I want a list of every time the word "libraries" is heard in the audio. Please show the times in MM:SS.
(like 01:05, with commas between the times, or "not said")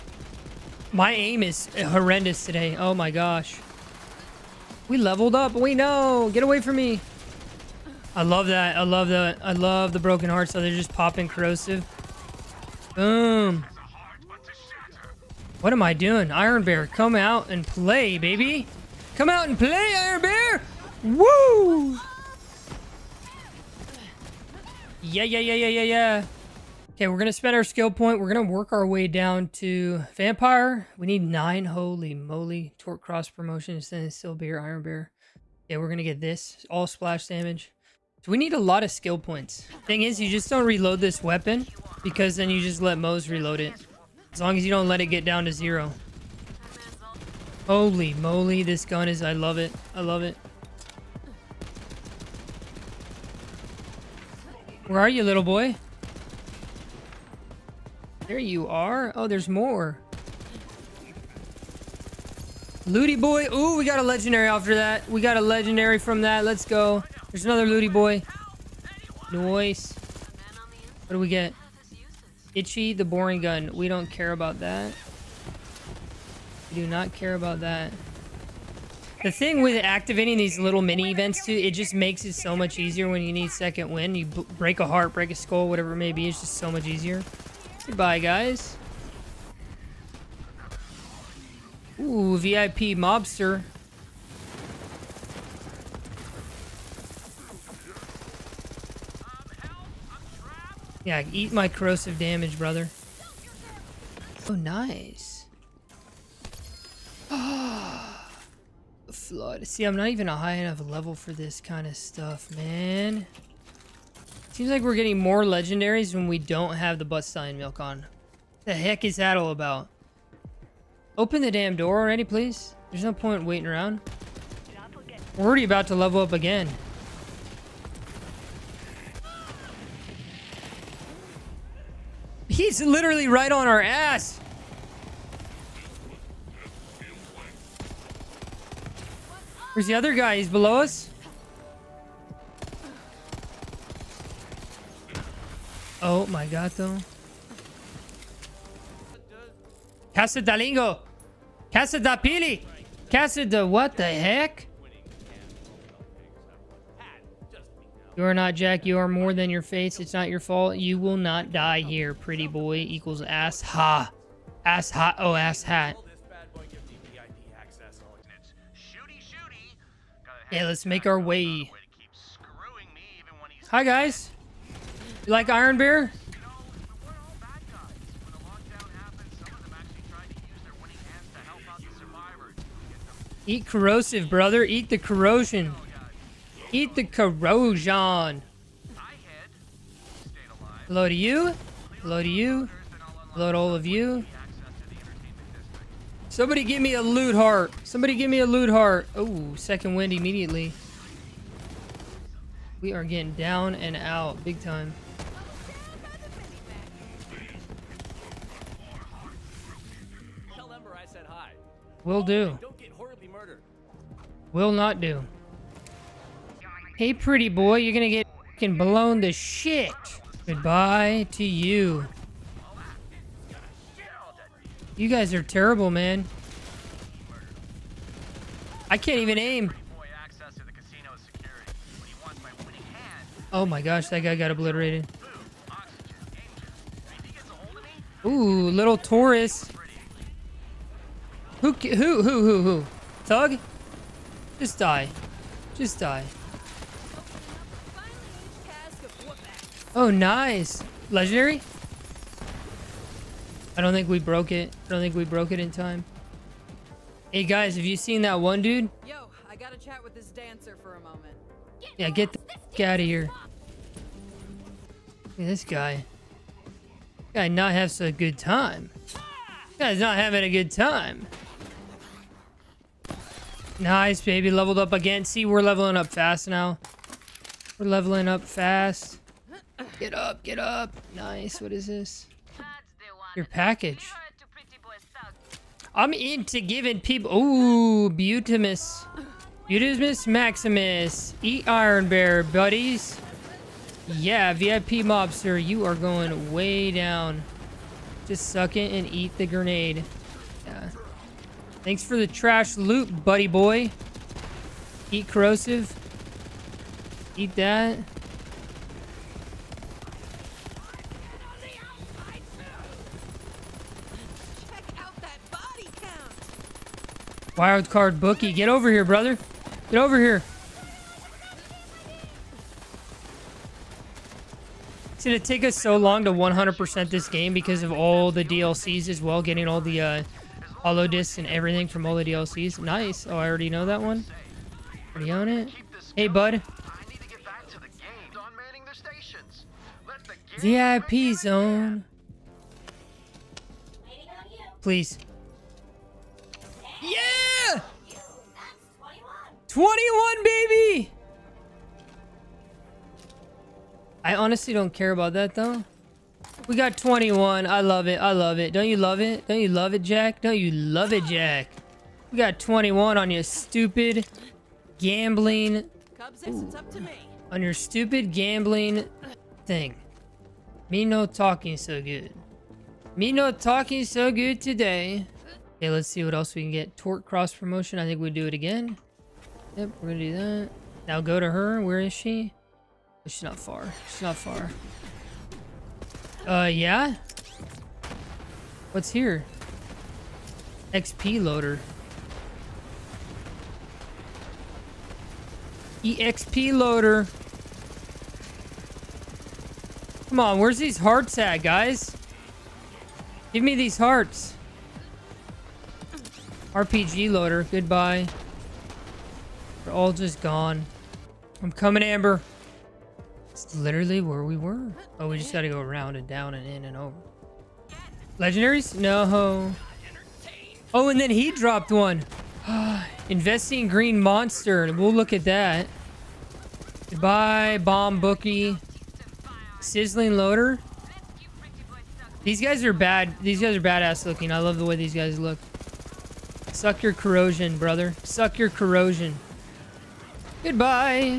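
not said.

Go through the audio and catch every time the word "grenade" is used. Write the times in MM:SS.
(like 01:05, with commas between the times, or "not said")
04:59.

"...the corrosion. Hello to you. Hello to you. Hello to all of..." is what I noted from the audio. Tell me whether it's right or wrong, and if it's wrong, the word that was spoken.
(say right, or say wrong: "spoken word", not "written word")
right.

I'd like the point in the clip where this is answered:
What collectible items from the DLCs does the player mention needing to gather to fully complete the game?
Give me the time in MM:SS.
05:30.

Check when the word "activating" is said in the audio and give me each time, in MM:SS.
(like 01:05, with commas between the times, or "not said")
01:19.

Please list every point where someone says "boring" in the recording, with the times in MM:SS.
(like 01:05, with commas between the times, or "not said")
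01:13.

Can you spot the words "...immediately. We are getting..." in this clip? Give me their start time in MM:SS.
03:20.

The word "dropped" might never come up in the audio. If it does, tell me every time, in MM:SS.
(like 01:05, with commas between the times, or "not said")
07:01.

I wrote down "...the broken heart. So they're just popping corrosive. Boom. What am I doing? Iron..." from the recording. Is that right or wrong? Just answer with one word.
right.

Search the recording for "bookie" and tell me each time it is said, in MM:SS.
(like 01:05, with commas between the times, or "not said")
05:18, 07:08.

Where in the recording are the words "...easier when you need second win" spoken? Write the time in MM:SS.
01:22.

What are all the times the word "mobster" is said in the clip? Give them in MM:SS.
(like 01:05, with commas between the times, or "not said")
01:32, 04:55.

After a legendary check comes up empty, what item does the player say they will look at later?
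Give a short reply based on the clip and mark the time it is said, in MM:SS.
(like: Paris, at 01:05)
green monster, at 07:03.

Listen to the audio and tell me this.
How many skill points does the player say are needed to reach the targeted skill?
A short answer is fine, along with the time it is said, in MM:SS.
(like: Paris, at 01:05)
9, at 00:31.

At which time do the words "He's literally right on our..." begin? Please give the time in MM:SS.
02:12.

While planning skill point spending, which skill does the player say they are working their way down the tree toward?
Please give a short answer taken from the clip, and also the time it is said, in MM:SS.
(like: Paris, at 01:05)
Vampyr, at 00:30.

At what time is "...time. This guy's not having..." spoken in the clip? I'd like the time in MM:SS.
04:28.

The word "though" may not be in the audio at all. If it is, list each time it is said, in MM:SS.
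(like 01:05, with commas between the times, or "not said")
05:55.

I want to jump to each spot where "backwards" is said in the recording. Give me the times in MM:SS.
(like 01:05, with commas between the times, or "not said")
not said.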